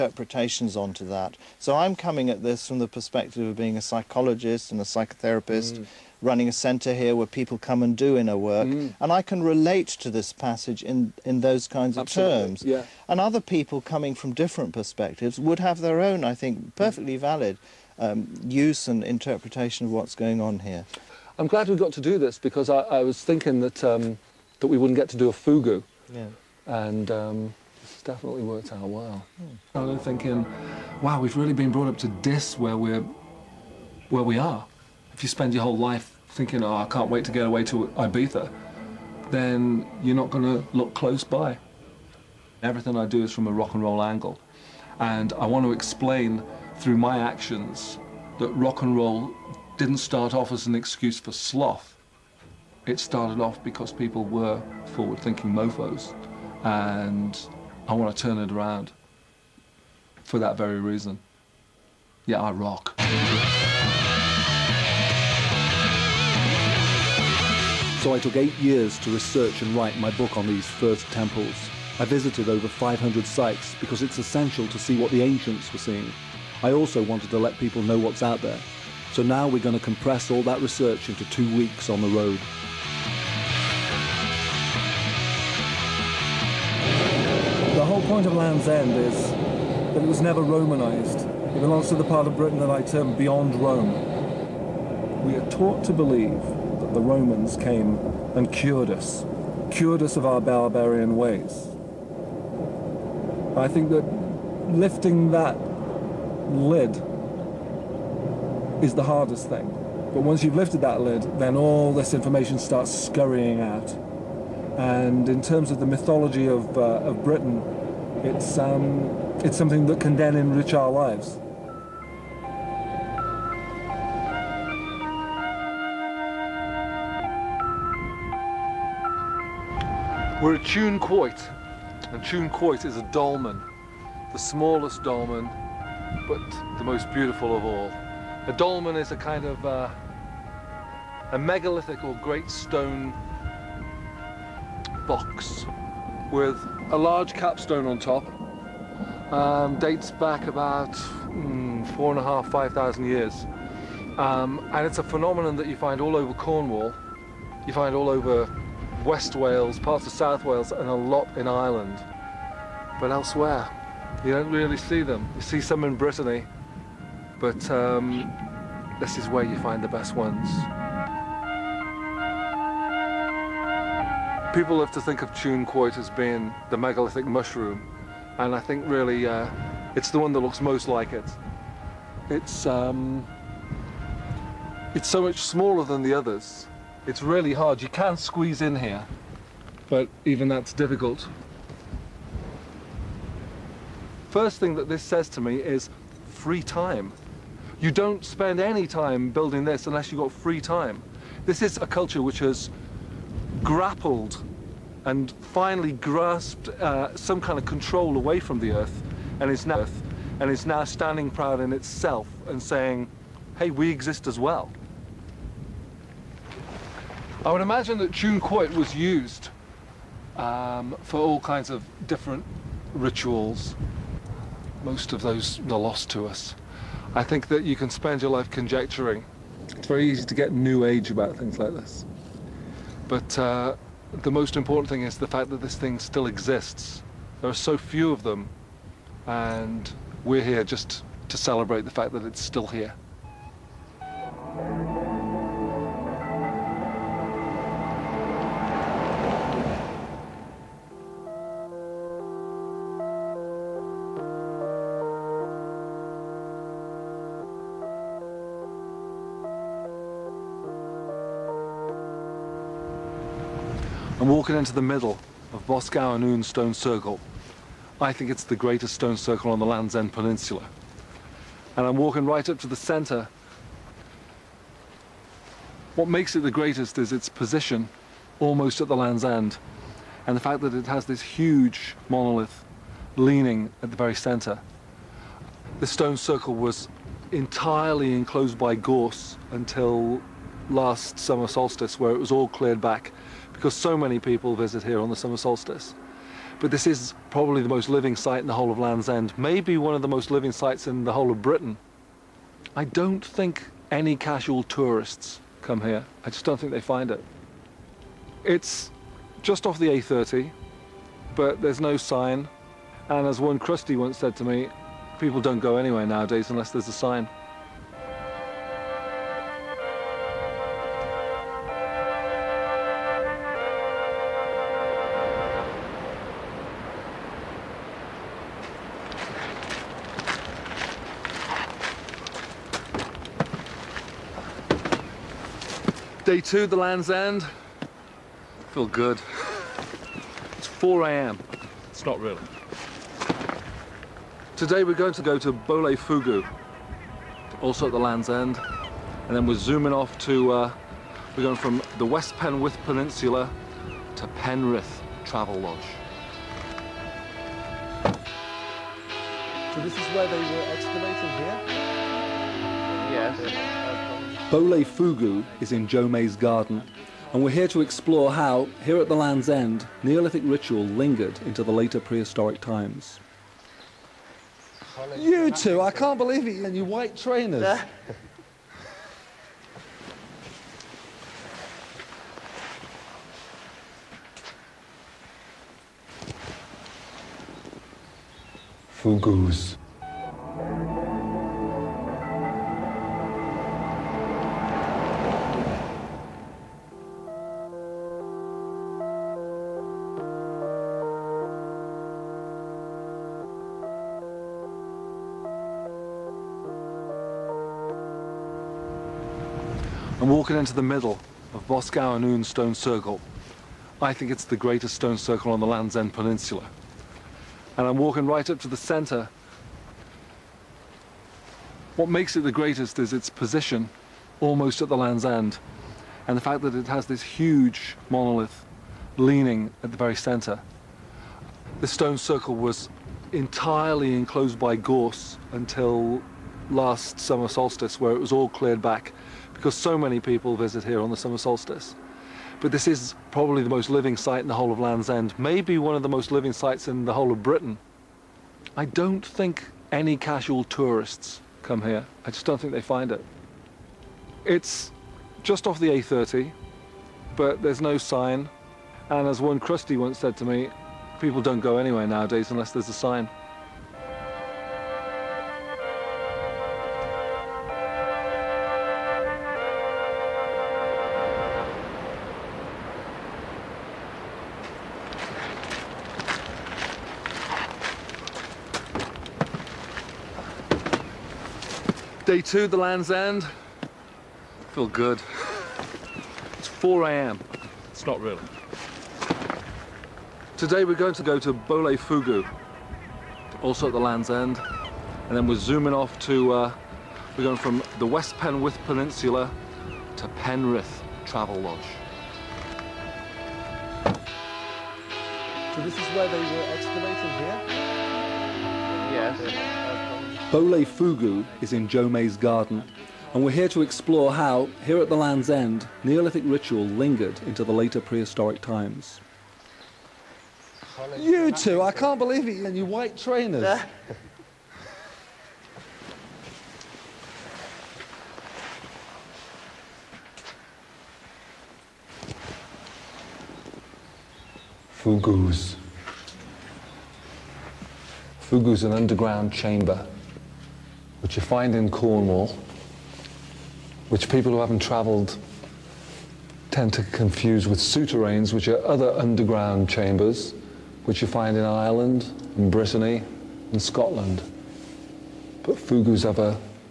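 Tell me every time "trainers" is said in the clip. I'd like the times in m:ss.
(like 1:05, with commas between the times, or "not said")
6:17, 8:43.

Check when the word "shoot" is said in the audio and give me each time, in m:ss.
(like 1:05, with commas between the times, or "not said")
not said.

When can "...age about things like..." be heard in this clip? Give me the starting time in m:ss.
3:50.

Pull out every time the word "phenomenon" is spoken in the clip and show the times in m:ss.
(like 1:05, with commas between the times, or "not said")
2:35.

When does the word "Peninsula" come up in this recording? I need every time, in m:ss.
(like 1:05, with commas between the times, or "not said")
4:30, 5:52, 6:56, 8:18.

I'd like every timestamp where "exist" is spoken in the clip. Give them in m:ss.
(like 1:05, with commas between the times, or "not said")
3:33, 3:56.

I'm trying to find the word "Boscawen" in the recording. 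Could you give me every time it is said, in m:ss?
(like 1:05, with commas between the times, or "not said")
4:25, 6:51.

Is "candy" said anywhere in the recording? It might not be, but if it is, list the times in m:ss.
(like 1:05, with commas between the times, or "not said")
not said.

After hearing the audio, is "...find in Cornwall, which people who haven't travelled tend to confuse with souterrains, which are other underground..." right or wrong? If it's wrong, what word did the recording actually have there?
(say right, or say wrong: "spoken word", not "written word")
right.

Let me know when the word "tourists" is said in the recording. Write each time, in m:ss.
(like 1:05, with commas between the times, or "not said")
5:04, 7:30.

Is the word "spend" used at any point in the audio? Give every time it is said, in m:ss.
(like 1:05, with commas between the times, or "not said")
0:35, 3:18, 3:47.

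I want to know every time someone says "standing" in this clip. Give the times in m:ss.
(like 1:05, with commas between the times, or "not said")
3:30.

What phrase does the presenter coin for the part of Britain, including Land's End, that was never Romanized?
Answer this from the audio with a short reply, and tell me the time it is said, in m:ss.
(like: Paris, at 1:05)
beyond Rome, at 1:33.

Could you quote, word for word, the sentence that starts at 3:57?
There are so few of them, and we're here just to celebrate the fact that it's still here.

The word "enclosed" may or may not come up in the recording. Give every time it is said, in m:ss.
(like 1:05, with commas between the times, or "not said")
4:48, 7:14.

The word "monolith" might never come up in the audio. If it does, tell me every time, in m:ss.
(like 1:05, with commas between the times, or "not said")
4:42, 7:08.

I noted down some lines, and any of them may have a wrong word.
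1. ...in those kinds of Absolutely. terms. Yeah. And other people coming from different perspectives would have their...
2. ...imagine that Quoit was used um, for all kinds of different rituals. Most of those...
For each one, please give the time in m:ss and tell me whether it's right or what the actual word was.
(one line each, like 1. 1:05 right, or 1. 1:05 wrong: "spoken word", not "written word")
1. 0:11 right
2. 3:37 right.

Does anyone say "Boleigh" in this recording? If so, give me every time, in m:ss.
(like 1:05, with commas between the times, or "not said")
5:45, 6:04, 8:11, 8:30.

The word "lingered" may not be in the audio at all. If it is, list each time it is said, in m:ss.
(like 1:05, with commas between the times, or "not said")
6:10, 8:36.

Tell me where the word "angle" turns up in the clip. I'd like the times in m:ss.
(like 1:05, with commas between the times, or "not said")
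0:44.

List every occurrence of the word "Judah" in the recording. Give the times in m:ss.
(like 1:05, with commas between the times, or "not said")
not said.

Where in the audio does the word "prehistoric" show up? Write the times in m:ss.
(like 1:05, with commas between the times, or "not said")
6:12, 8:38.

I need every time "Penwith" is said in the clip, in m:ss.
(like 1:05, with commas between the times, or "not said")
5:52, 8:18.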